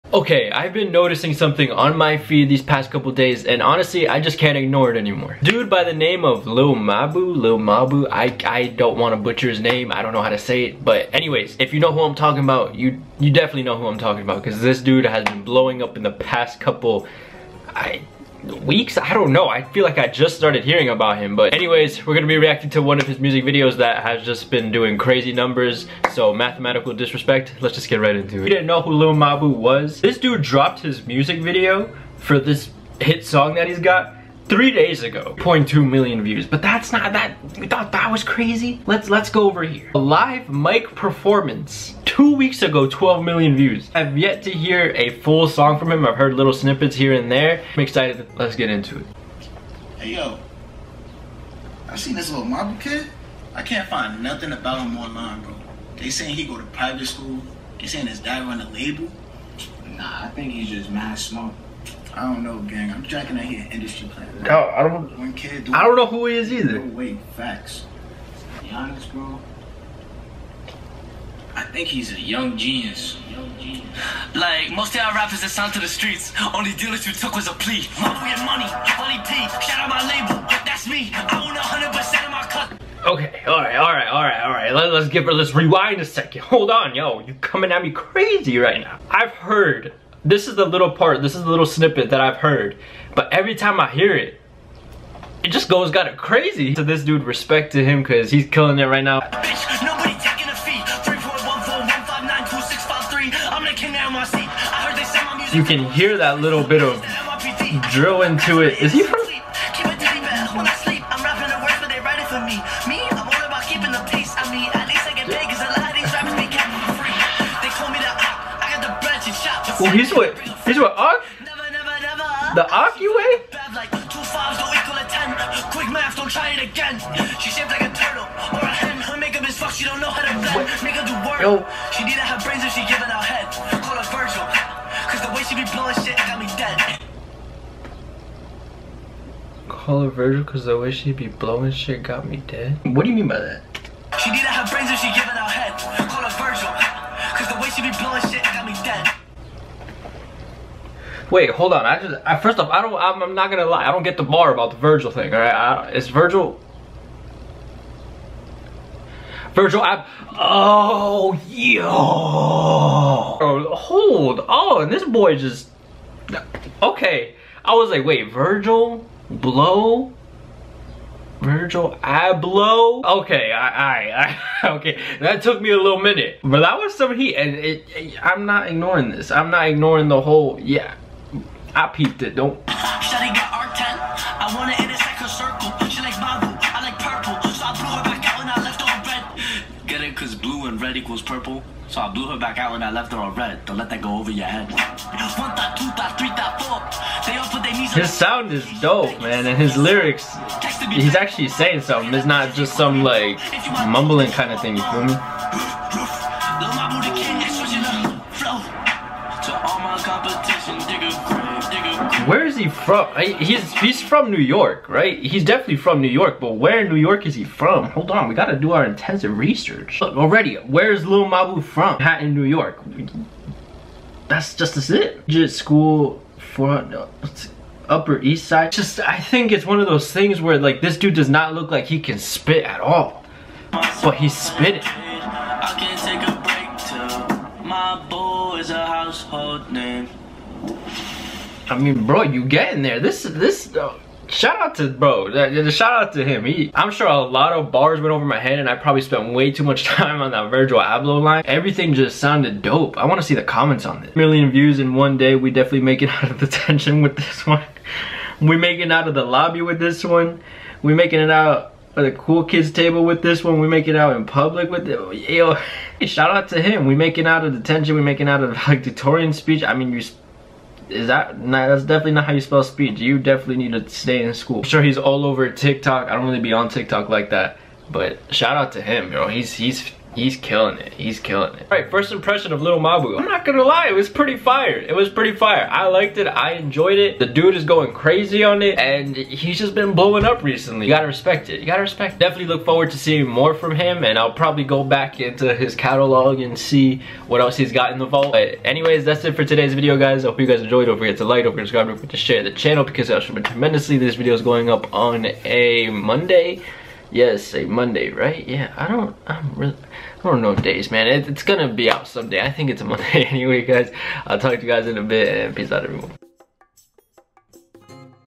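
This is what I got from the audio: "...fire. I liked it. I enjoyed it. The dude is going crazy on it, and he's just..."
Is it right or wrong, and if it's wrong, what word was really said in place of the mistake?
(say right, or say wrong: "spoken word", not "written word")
right.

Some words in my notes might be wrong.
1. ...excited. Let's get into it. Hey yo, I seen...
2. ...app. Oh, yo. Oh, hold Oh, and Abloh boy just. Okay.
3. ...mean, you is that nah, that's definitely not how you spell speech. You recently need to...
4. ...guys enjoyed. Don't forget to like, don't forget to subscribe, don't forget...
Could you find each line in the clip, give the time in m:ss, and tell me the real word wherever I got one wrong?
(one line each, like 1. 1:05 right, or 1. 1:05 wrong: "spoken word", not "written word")
1. 0:47 right
2. 2:39 wrong: "This", not "Abloh"
3. 4:29 wrong: "definitely", not "recently"
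4. 5:00 right.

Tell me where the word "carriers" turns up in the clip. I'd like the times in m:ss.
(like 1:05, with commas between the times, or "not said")
not said.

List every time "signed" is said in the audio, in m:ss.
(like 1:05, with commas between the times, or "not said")
1:15.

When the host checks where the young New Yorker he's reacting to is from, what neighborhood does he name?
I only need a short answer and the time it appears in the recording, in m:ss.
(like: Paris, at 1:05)
Upper East Side, at 3:47.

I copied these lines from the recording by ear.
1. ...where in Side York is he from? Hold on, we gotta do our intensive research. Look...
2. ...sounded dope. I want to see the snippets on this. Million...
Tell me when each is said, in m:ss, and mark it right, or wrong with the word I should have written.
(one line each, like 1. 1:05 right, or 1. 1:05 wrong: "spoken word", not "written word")
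1. 3:36 wrong: "New", not "Side"
2. 4:12 wrong: "comments", not "snippets".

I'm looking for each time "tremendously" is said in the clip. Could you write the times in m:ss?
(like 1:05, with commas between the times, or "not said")
5:03.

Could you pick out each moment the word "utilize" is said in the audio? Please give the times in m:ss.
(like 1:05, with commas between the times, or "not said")
not said.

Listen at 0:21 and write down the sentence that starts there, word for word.
But anyways, we're going to be reacting to one of his music videos that has just been doing crazy numbers.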